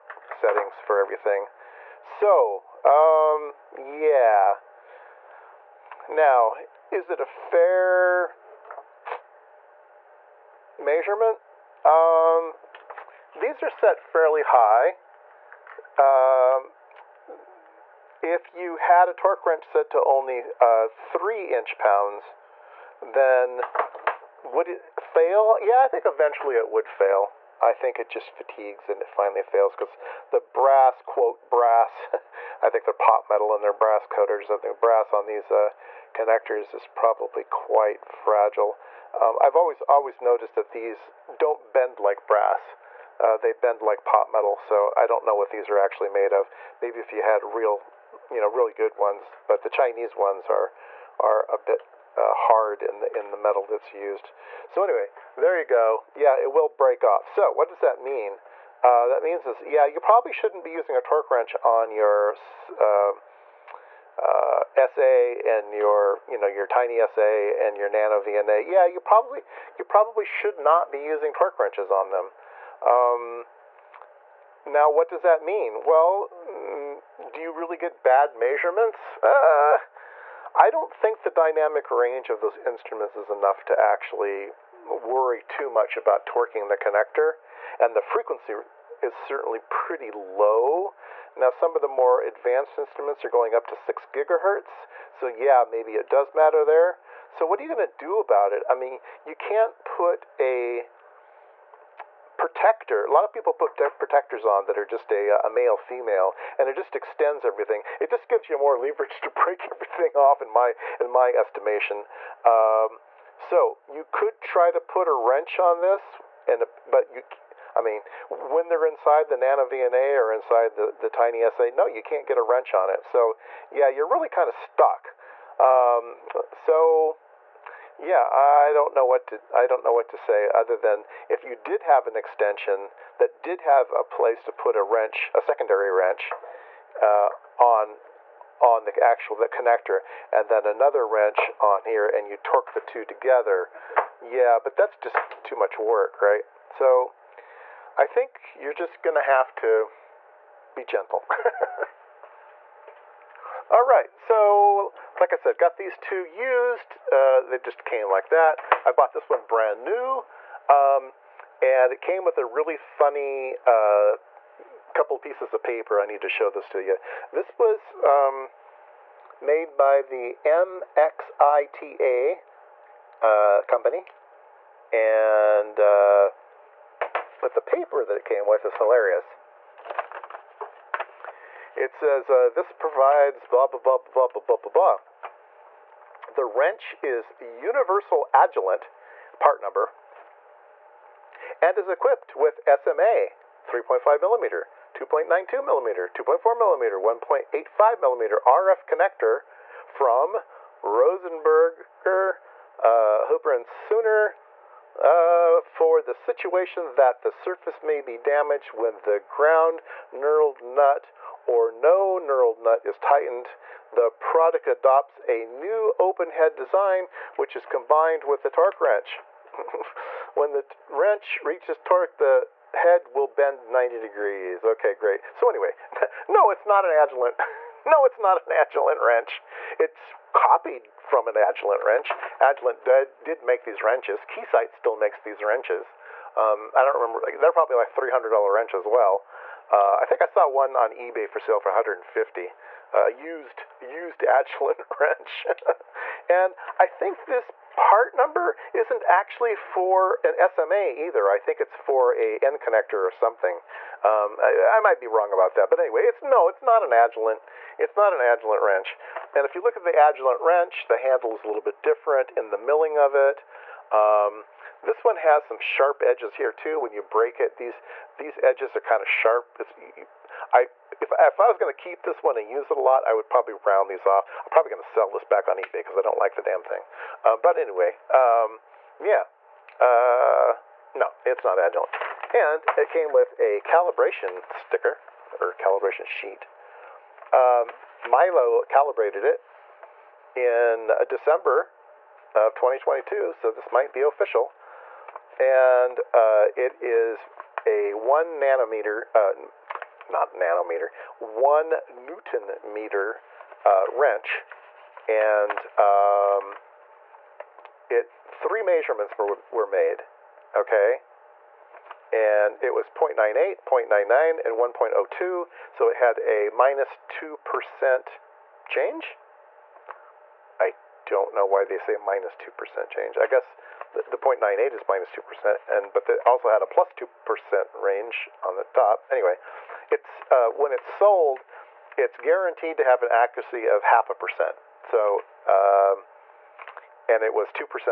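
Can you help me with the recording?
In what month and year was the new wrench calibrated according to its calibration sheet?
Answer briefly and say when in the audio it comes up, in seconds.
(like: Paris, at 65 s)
December 2022, at 291 s.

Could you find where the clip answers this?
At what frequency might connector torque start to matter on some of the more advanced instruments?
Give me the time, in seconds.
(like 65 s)
93 s.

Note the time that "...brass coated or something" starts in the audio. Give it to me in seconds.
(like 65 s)
33 s.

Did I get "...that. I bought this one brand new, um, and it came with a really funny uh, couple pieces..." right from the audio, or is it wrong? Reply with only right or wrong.
right.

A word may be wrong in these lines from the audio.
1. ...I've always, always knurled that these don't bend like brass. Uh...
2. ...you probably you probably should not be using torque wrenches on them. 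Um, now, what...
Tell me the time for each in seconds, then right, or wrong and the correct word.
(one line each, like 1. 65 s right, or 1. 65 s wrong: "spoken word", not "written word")
1. 39 s wrong: "noticed", not "knurled"
2. 68 s right.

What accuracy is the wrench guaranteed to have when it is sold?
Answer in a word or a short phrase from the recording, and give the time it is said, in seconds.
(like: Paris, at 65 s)
half a percent, at 333 s.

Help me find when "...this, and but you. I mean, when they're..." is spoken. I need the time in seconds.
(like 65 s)
115 s.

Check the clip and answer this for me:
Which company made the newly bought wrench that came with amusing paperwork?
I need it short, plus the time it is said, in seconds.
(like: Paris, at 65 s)
MXITA, at 170 s.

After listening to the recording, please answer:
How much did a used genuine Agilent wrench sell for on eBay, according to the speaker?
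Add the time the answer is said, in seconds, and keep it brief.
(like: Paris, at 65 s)
150, at 241 s.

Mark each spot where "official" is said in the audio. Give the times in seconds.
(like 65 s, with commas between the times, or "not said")
294 s.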